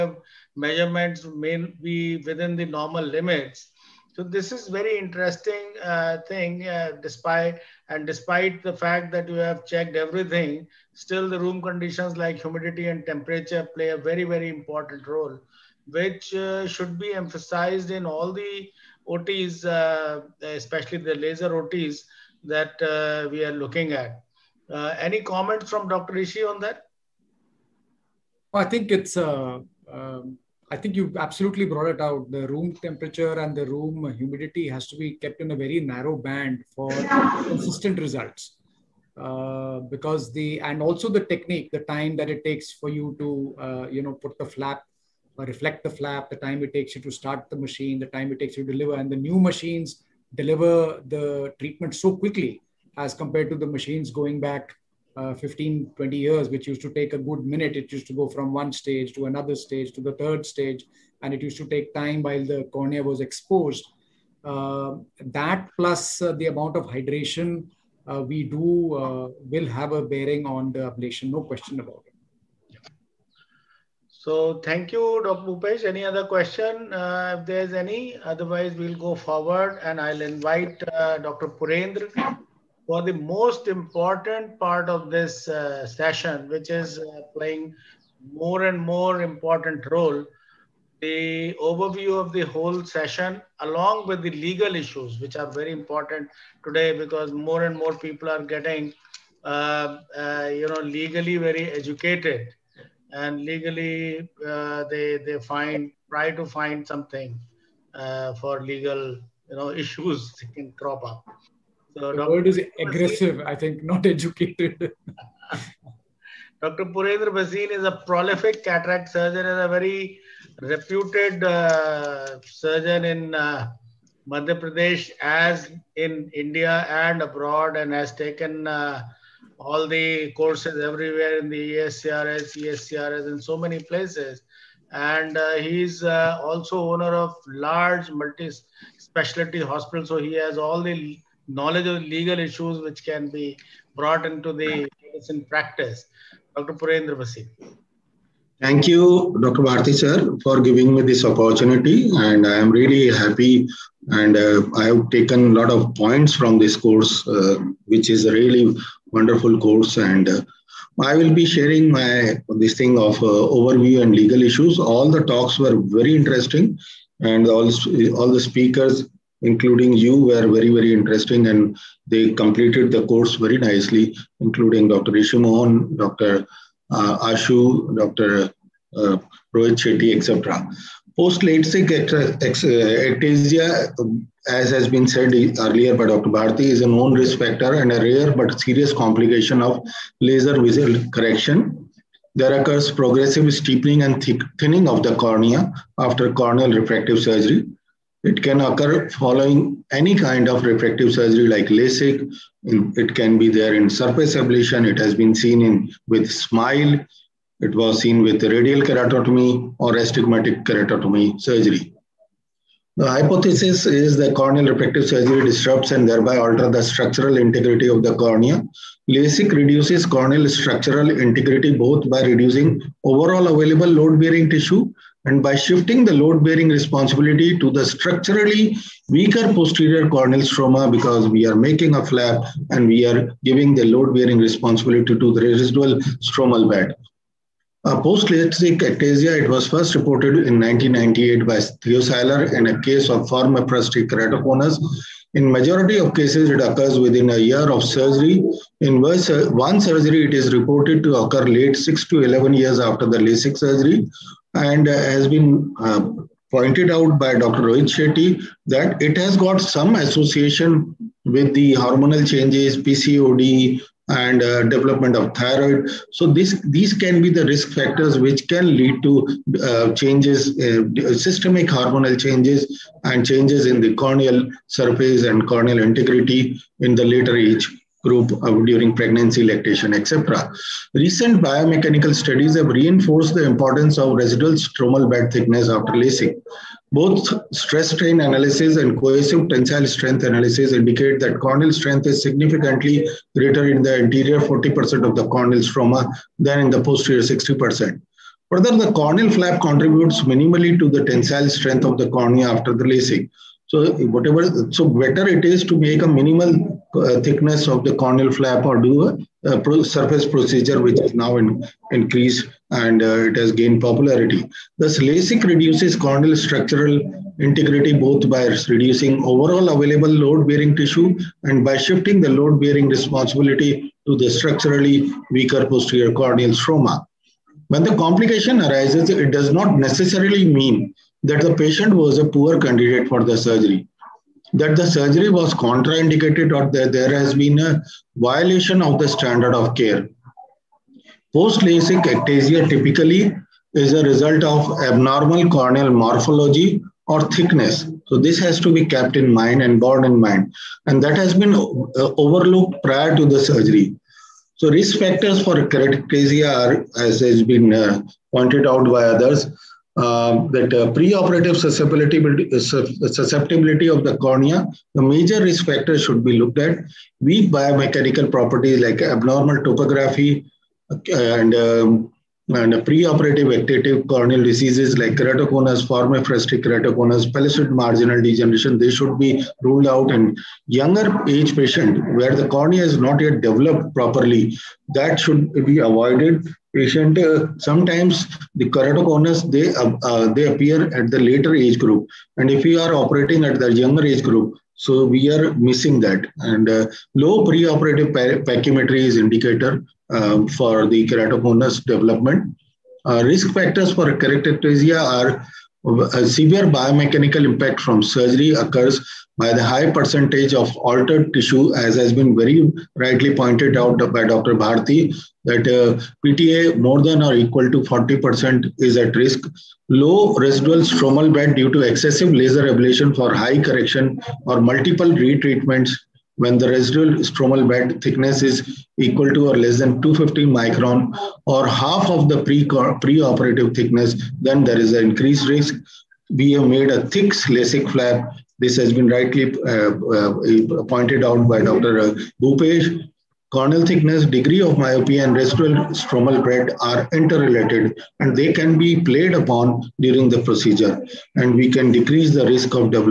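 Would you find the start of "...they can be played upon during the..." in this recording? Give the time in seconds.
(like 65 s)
448 s.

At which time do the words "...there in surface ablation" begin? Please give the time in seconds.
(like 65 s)
203 s.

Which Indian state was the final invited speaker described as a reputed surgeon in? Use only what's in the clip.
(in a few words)
Madhya Pradesh.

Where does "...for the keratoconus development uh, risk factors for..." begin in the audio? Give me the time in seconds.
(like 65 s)
400 s.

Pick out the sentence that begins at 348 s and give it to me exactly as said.
So this has to be kept in mind and borne in mind.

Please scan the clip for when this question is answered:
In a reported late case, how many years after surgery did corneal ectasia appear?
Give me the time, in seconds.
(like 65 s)
251 s.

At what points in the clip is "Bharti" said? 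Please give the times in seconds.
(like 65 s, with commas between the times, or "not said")
149 s, 186 s, 414 s.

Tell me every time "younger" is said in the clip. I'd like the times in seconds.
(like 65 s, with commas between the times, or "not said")
380 s, 393 s.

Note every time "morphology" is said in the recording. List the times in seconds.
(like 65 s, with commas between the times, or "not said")
345 s.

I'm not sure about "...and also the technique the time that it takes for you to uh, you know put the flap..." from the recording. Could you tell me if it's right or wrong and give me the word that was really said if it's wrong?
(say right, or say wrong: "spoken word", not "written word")
right.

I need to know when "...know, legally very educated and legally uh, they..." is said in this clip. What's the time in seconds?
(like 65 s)
100 s.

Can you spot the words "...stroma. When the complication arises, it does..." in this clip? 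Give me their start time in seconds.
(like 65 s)
326 s.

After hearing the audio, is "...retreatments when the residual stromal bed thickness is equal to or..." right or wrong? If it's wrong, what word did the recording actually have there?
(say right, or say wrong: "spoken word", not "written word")
right.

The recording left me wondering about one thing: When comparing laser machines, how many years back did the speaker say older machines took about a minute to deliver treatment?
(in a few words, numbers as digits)
15-20 years.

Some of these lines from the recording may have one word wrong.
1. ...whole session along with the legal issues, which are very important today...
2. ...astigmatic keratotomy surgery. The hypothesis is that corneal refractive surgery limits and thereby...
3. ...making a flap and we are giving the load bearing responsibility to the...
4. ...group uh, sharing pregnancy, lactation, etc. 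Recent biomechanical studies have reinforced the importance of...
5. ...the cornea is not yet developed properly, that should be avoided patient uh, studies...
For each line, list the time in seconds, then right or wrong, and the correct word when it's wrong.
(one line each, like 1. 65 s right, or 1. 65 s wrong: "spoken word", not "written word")
1. 92 s right
2. 209 s wrong: "disrupts", not "limits"
3. 231 s right
4. 278 s wrong: "during", not "sharing"
5. 382 s wrong: "sometimes", not "studies".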